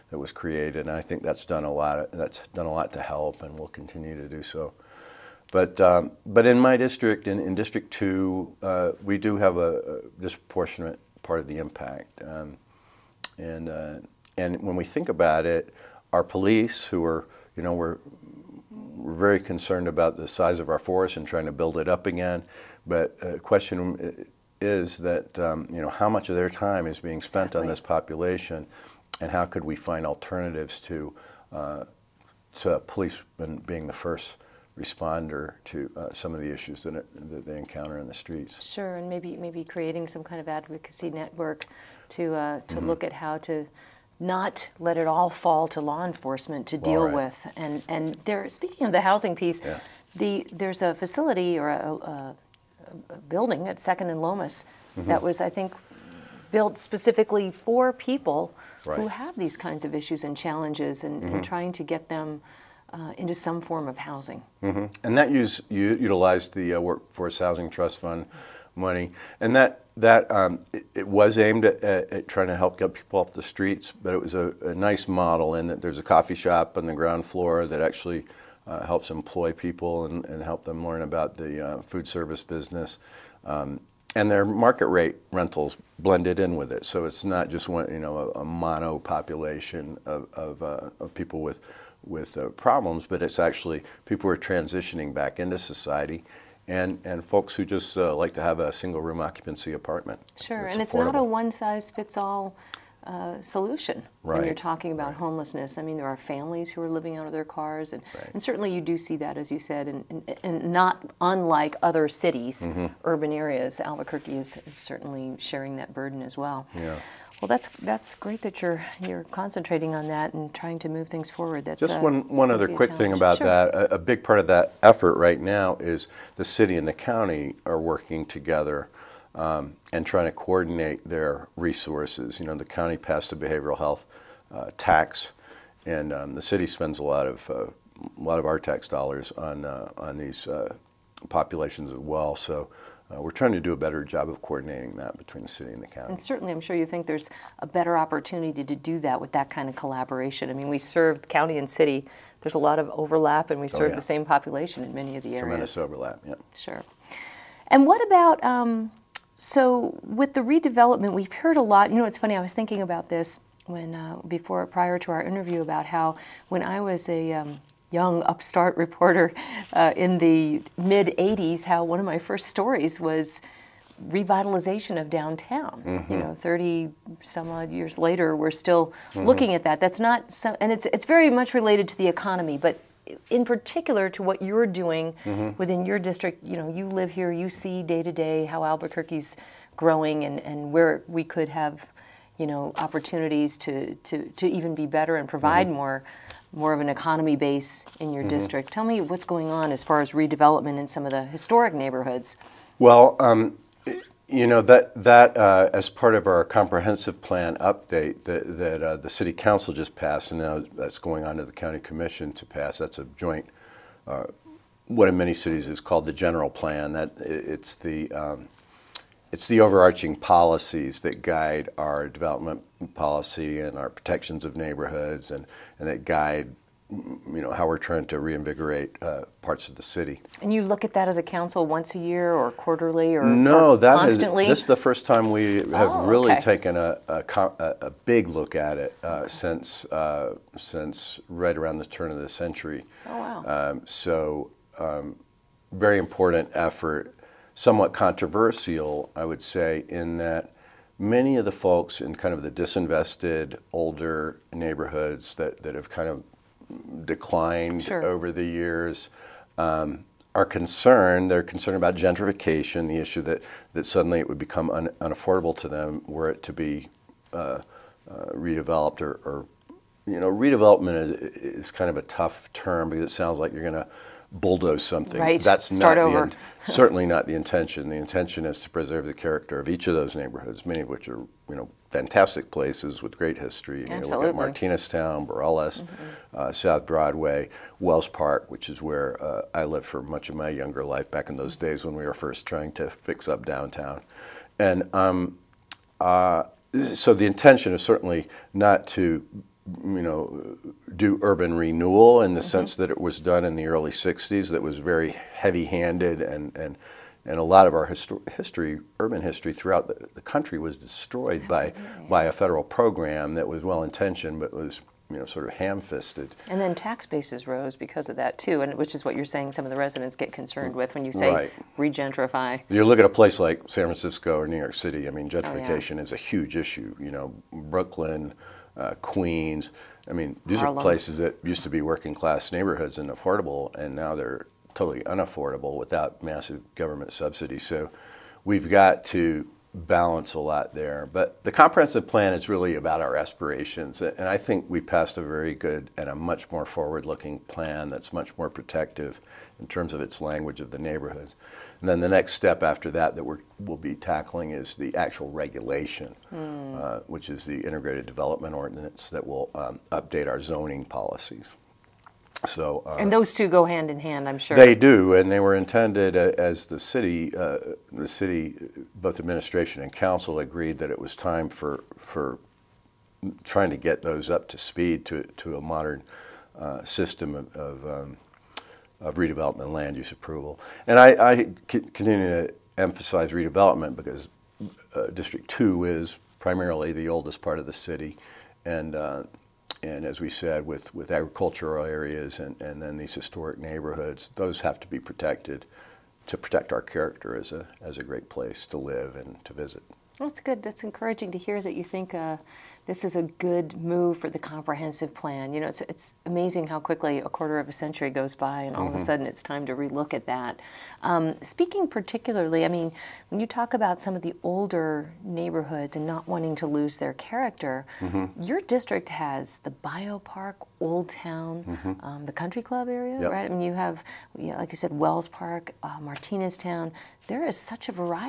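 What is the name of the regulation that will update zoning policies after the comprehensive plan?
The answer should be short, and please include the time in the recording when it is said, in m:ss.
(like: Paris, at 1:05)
integrated development ordinance, at 5:57.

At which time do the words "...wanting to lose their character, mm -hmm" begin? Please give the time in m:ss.
6:56.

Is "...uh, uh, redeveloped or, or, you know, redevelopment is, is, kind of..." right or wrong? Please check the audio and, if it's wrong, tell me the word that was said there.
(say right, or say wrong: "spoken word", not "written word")
right.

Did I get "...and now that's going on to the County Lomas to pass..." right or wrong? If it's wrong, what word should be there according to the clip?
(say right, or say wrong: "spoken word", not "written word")
wrong: "Commission", not "Lomas".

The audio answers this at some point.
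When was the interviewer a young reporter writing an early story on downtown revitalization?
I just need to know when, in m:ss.
2:50.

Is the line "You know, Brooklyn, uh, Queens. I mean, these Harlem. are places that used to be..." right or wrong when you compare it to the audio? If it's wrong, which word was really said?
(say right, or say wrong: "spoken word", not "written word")
right.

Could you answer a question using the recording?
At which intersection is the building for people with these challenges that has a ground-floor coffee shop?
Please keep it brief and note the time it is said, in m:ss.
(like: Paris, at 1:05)
Second and Lomas, at 0:53.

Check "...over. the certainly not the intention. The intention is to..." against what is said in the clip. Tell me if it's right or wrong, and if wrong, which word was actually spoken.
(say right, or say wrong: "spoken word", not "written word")
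right.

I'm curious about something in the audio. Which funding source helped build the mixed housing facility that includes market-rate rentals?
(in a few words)
Workforce Housing Trust Fund.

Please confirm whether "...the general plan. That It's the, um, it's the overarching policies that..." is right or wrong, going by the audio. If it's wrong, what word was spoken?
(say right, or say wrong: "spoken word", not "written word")
right.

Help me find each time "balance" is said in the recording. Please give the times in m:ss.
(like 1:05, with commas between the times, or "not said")
5:39.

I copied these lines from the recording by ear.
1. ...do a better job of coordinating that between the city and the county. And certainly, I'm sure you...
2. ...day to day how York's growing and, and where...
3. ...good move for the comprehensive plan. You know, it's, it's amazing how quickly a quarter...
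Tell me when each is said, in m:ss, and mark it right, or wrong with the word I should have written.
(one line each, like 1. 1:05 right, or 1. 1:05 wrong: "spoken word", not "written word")
1. 2:23 right
2. 3:07 wrong: "Albuquerque", not "York"
3. 6:43 right.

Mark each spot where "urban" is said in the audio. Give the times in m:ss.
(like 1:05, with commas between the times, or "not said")
1:53, 5:01, 5:08.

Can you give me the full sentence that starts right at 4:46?
uh, South Broadway, Wells Park, which is where uh, I lived for much of my younger life back in those mm-hmm.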